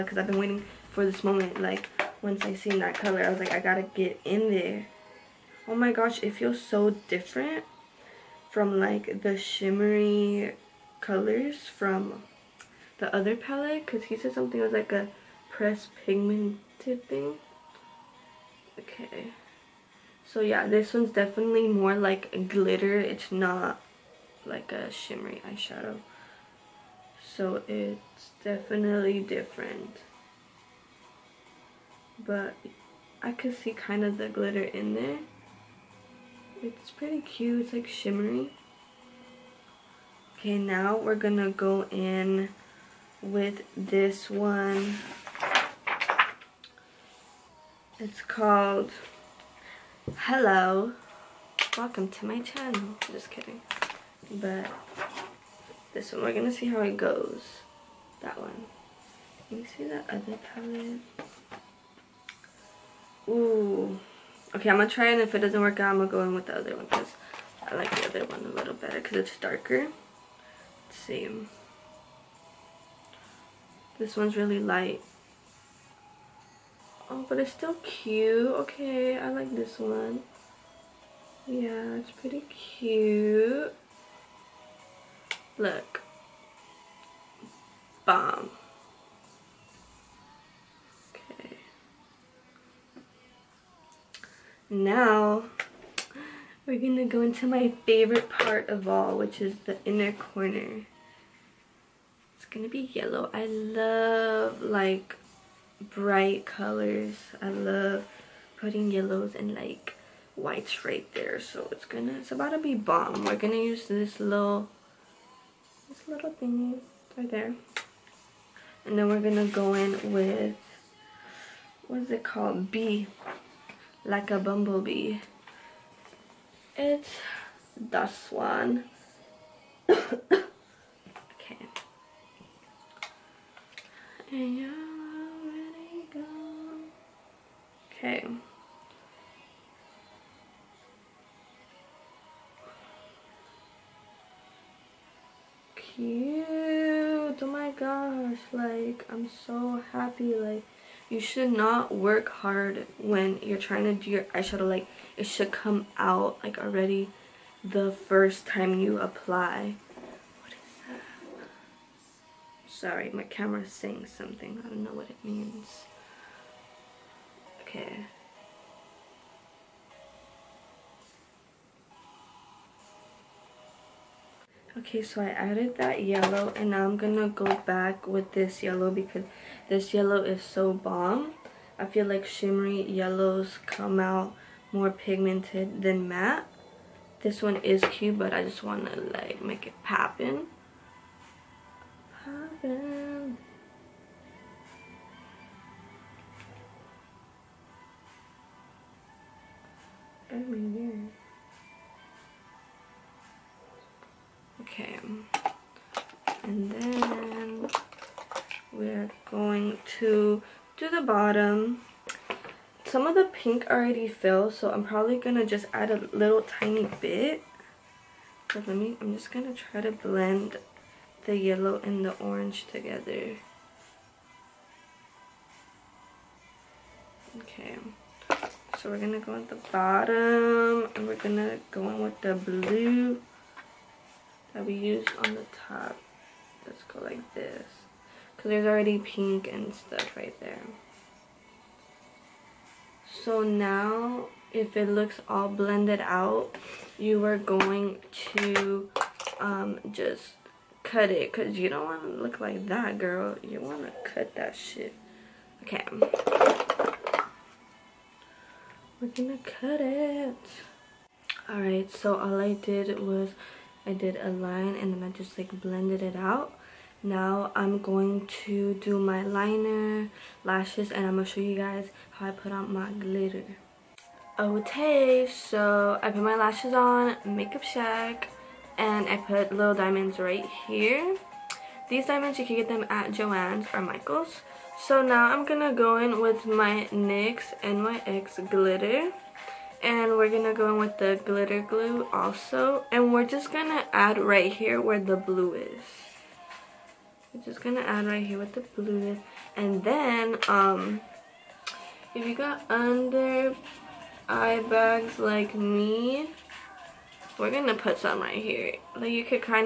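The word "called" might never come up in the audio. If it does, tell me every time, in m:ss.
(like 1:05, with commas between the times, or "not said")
0:48, 2:02.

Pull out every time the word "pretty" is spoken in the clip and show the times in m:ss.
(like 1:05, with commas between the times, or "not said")
0:36, 1:22.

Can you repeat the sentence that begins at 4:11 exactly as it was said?
Because you don't want to look like that, girl.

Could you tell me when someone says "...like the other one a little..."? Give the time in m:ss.
1:07.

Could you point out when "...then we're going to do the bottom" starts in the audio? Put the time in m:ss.
3:26.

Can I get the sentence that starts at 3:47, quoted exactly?
Okay, so we're gonna go at the bottom and we're gonna go in with the blue that we used on the top.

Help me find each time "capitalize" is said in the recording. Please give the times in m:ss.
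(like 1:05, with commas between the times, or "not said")
not said.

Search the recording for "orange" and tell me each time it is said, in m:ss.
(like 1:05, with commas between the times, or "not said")
3:42.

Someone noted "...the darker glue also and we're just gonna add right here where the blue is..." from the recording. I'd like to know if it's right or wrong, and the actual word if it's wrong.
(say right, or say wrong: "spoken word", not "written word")
wrong: "glitter", not "darker".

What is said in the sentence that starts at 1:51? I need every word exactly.
So it's gonna, it's about to be bomb.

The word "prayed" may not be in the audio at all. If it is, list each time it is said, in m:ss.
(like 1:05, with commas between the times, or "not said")
not said.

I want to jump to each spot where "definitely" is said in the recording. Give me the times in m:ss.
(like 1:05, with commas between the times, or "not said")
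0:21, 0:28.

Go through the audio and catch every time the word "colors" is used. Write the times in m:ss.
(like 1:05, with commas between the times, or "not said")
0:02, 0:11, 1:46.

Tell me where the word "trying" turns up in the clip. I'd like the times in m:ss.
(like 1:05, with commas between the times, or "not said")
2:33.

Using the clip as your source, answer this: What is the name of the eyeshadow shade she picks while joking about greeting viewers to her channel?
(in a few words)
Hello.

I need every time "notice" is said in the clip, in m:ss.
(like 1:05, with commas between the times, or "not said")
not said.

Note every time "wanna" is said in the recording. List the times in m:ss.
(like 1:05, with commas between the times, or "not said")
3:08.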